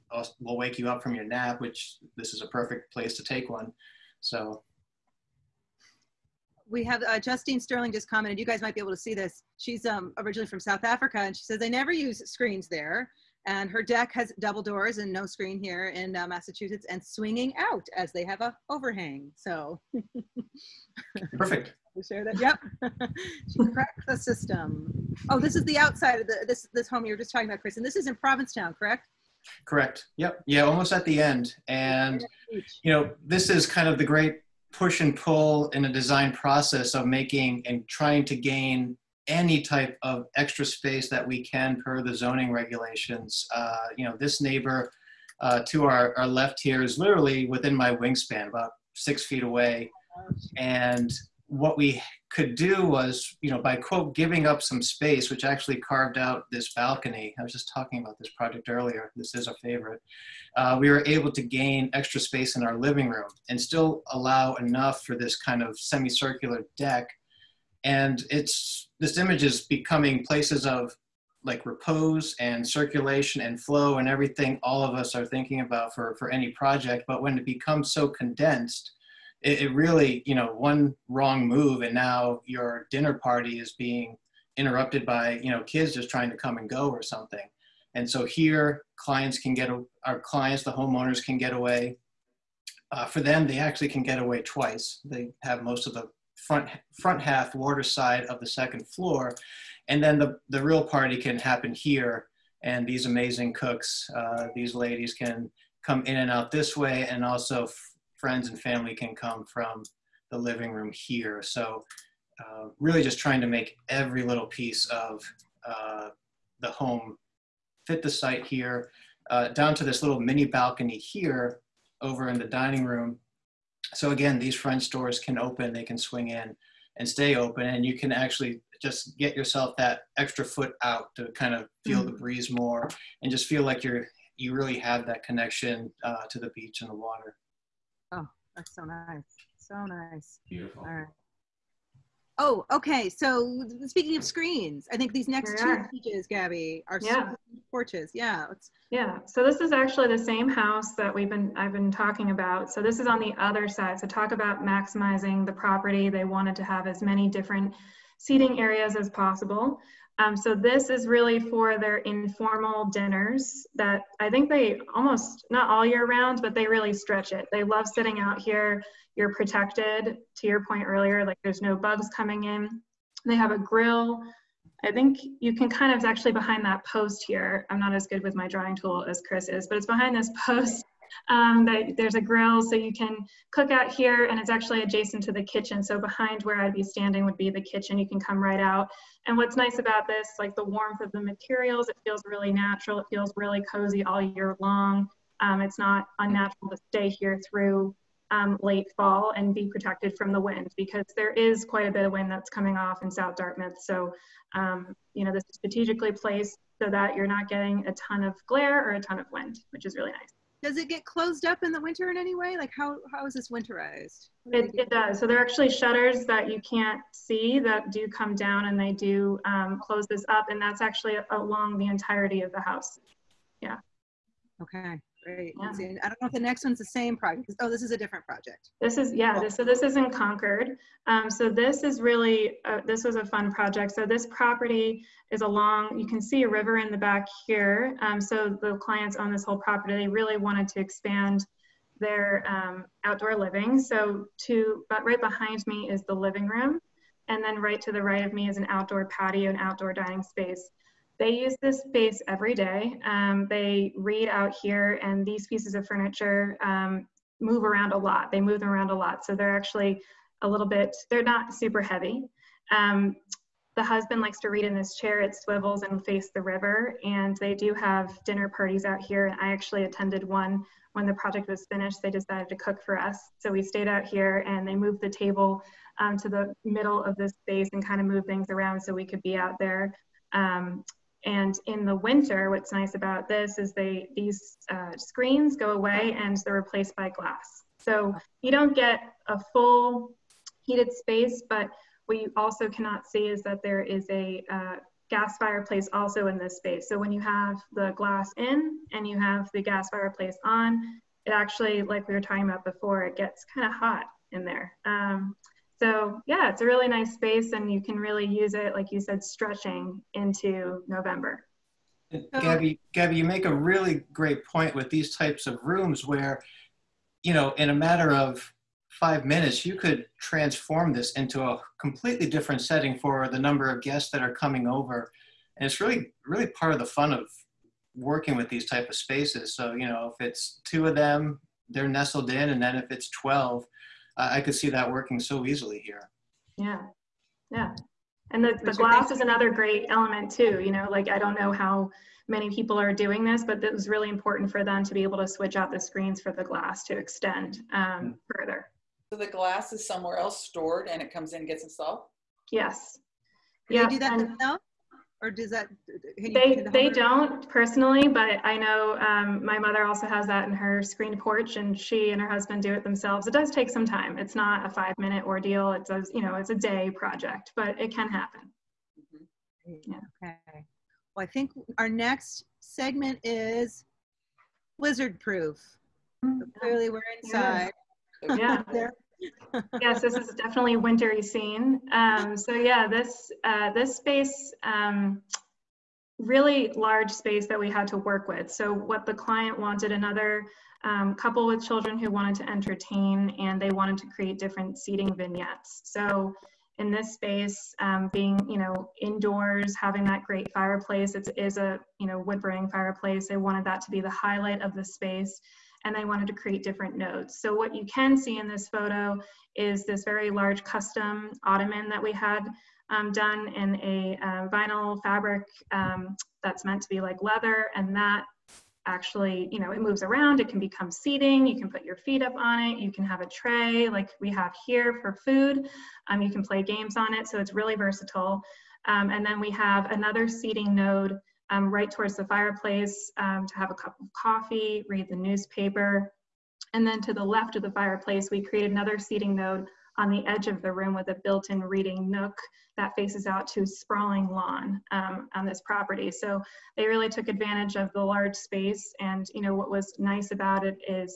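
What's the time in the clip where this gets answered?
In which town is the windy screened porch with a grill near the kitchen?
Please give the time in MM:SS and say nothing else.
03:23.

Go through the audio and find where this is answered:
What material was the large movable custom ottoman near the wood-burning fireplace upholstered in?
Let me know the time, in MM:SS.
06:54.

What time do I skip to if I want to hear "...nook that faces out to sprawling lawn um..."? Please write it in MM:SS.
07:22.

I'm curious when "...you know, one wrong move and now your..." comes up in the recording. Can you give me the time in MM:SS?
01:20.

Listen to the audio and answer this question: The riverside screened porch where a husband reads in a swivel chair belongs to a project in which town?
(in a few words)
Concord.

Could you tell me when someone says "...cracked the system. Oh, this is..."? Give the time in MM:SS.
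00:23.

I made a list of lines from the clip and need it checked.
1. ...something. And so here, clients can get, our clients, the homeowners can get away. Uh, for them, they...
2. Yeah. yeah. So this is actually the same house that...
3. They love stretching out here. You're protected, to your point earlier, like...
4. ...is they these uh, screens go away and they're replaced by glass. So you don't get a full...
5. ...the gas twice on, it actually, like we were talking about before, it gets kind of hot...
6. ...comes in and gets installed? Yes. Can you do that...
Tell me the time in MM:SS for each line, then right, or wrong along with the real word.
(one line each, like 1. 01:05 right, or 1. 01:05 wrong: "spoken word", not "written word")
1. 01:27 right
2. 02:28 right
3. 02:47 wrong: "sitting", not "stretching"
4. 04:43 right
5. 04:59 wrong: "fireplace", not "twice"
6. 05:51 right.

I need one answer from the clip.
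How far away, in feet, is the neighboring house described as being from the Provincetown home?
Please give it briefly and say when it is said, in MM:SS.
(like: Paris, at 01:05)
6, at 00:48.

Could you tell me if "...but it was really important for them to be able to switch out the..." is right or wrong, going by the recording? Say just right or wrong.
right.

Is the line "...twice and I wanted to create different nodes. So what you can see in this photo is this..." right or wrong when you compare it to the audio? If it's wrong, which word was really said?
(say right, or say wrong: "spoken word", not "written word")
wrong: "space", not "twice".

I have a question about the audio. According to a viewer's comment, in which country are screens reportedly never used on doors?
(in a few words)
South Africa.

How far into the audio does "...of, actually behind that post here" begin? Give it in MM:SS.
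02:55.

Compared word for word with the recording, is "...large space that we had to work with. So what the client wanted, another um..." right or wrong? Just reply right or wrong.
right.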